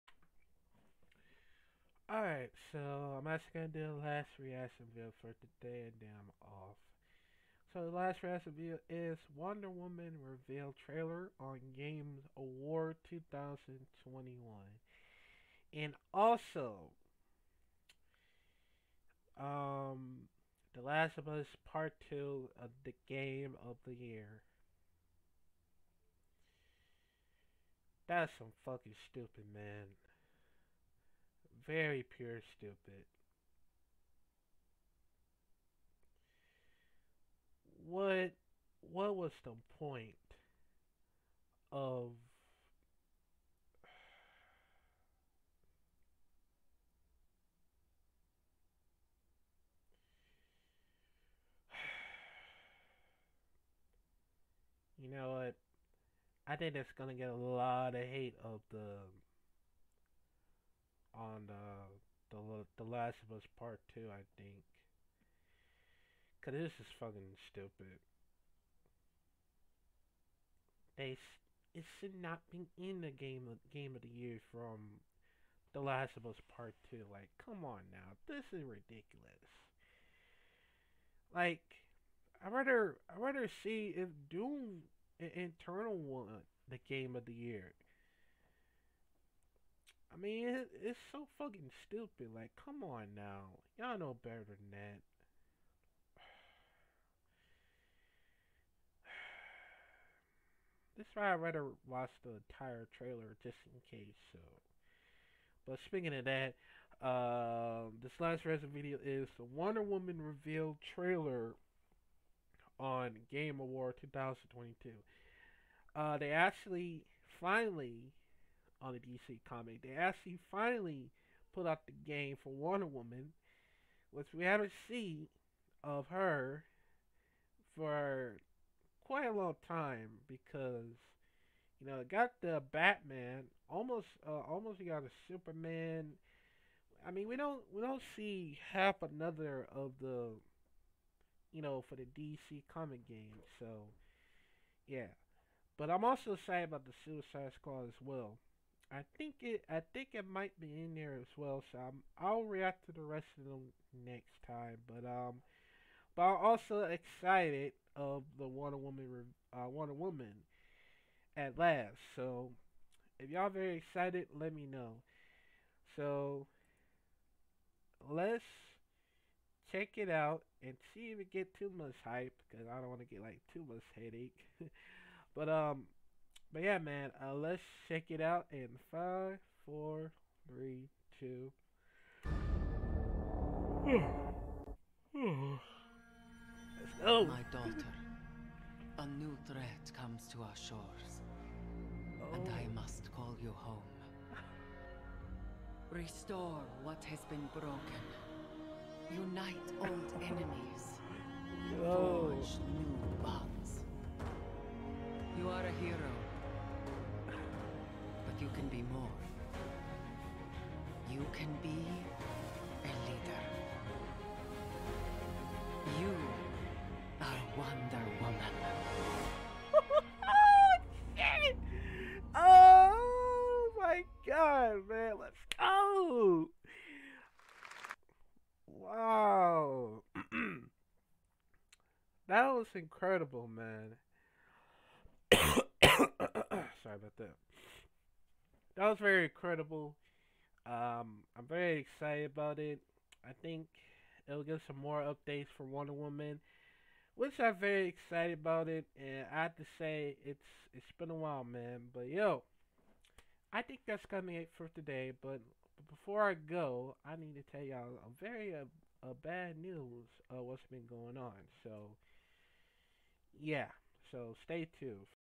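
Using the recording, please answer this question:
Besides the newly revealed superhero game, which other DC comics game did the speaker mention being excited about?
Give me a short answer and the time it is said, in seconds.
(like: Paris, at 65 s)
Suicide Squad, at 147 s.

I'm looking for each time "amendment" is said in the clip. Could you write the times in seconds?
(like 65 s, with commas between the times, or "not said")
not said.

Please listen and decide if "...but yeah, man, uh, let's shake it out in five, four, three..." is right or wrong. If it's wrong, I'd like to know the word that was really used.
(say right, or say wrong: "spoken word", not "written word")
right.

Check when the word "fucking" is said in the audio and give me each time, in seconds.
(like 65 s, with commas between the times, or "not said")
28 s, 66 s, 91 s.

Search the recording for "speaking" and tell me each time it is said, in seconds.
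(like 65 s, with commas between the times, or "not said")
105 s.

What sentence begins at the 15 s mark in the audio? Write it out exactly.
And also, um, The Last of Us Part 2 of the Game of the Year.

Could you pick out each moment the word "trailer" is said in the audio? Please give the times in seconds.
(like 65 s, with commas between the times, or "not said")
10 s, 102 s, 110 s.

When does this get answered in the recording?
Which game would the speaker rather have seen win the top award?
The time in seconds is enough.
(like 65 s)
84 s.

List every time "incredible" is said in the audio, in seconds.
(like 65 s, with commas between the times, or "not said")
232 s, 239 s.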